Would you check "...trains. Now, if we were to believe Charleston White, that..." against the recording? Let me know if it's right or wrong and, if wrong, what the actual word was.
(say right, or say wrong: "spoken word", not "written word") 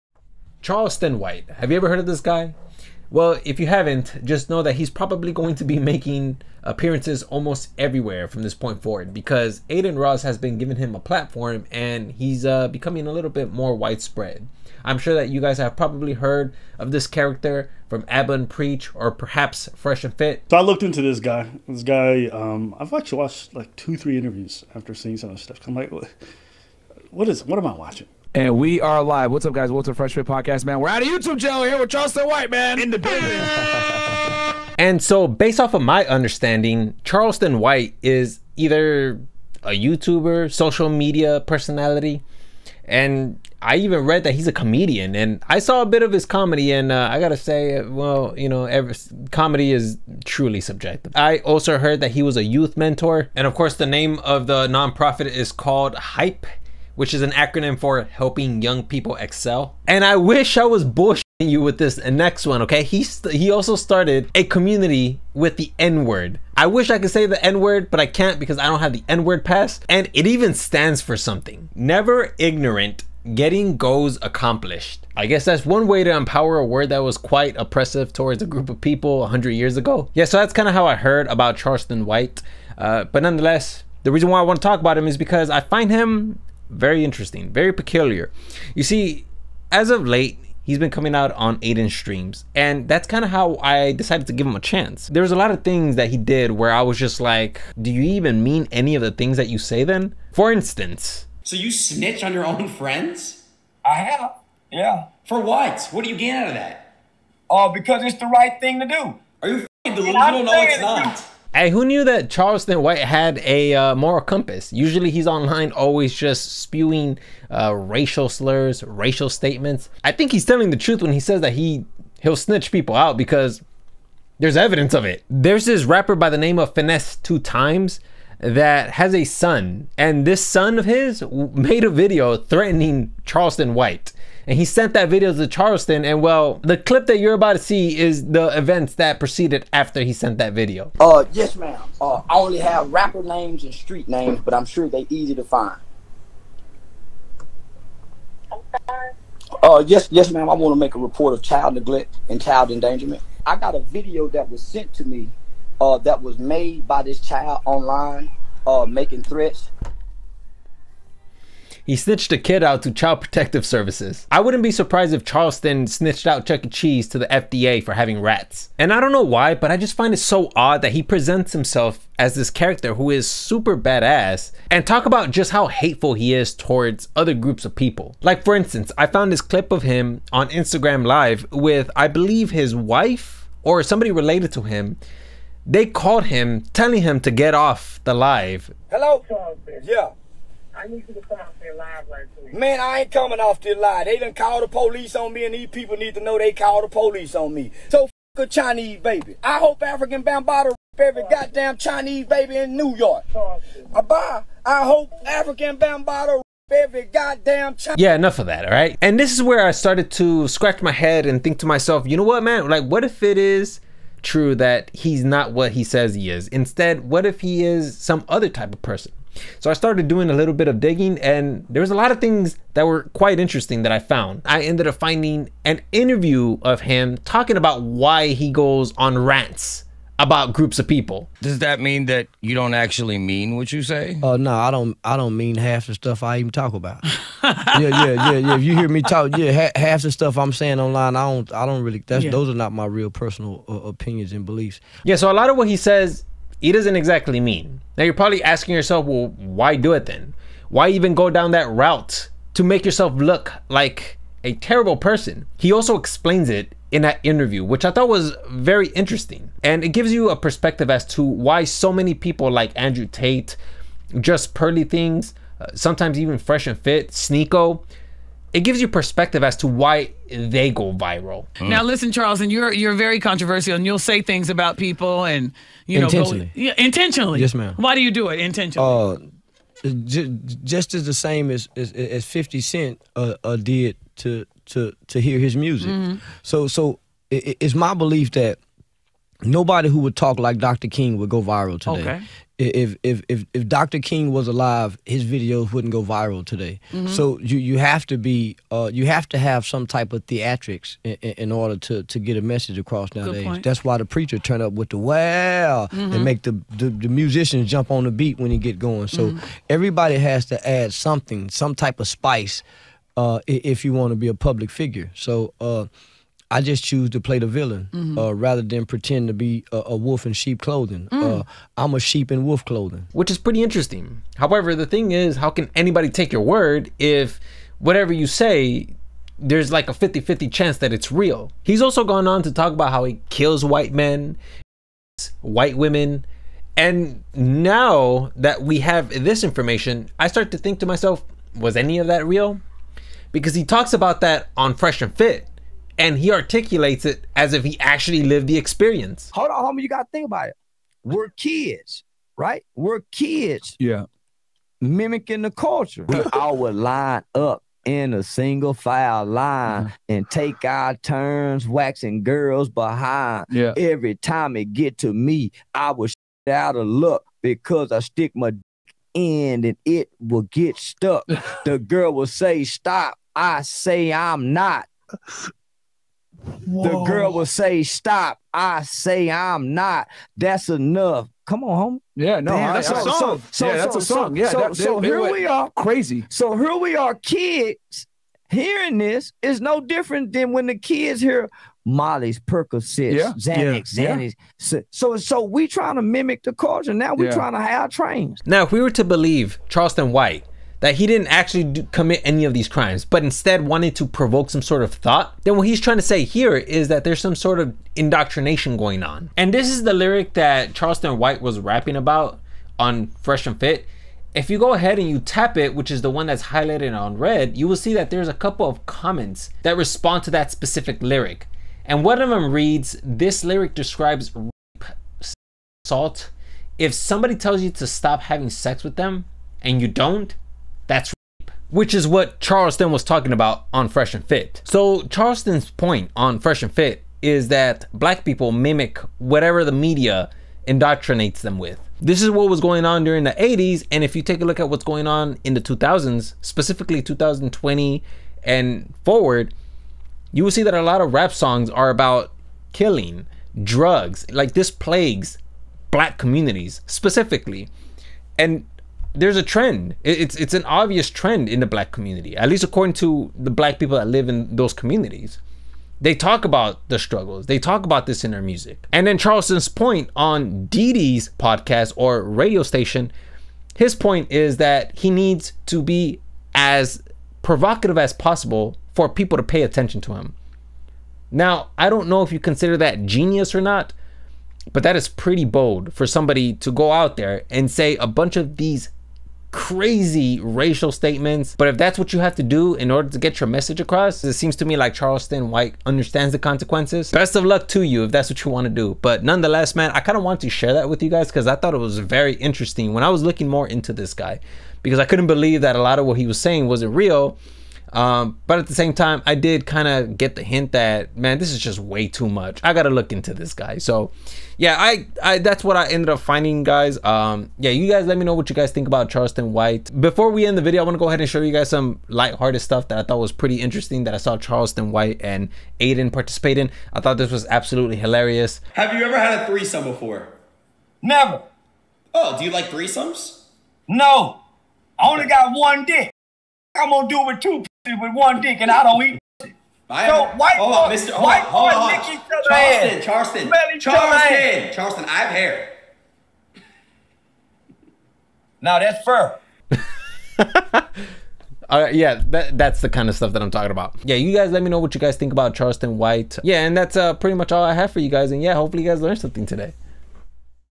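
right.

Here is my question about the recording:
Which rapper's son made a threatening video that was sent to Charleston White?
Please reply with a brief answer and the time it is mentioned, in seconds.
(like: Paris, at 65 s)
Finesse2Tymes, at 126 s.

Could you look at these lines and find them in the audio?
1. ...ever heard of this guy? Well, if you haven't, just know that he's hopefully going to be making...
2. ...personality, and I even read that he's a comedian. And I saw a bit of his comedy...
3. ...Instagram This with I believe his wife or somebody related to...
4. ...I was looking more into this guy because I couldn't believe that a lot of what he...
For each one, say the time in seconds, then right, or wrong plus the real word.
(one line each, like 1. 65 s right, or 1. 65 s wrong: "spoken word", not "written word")
1. 1 s wrong: "probably", not "hopefully"
2. 41 s right
3. 180 s wrong: "Live", not "This"
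4. 503 s right.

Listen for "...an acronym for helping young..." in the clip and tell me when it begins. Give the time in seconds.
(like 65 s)
57 s.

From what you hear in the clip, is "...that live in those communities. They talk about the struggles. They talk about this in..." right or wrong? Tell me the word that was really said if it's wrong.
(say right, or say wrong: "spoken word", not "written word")
right.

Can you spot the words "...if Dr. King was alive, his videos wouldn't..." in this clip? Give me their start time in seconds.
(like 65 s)
293 s.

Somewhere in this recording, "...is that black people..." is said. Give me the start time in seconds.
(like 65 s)
437 s.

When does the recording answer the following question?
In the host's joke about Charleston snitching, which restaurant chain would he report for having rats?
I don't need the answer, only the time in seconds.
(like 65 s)
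166 s.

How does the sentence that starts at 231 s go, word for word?
Does that mean that you don't actually mean what you say?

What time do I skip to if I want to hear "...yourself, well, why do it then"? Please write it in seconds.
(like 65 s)
248 s.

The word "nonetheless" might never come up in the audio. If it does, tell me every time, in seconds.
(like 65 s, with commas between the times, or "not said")
83 s, 499 s.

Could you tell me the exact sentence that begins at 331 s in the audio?
He's also gone on to talk about how he kills white men, white women.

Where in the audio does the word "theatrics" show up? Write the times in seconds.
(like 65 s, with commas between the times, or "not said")
300 s.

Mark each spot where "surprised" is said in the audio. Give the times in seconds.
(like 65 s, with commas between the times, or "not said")
164 s.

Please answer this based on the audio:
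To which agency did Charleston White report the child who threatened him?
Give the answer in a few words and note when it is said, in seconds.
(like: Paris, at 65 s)
Child Protective Services, at 162 s.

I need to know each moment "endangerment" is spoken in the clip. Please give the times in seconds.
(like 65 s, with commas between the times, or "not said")
152 s.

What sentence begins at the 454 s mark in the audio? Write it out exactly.
Like this plagues black communities specifically.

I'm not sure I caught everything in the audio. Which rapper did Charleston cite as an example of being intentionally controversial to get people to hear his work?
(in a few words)
Fifty Cent.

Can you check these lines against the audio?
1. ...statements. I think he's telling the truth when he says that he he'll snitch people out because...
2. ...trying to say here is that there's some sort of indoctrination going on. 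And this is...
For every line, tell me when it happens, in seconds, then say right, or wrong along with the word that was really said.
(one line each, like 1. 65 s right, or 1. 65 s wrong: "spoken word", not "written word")
1. 119 s right
2. 405 s right.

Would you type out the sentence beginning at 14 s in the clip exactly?
I'm sure that you guys have probably heard of this character from Aba and Preach or perhaps Fresh and Fit.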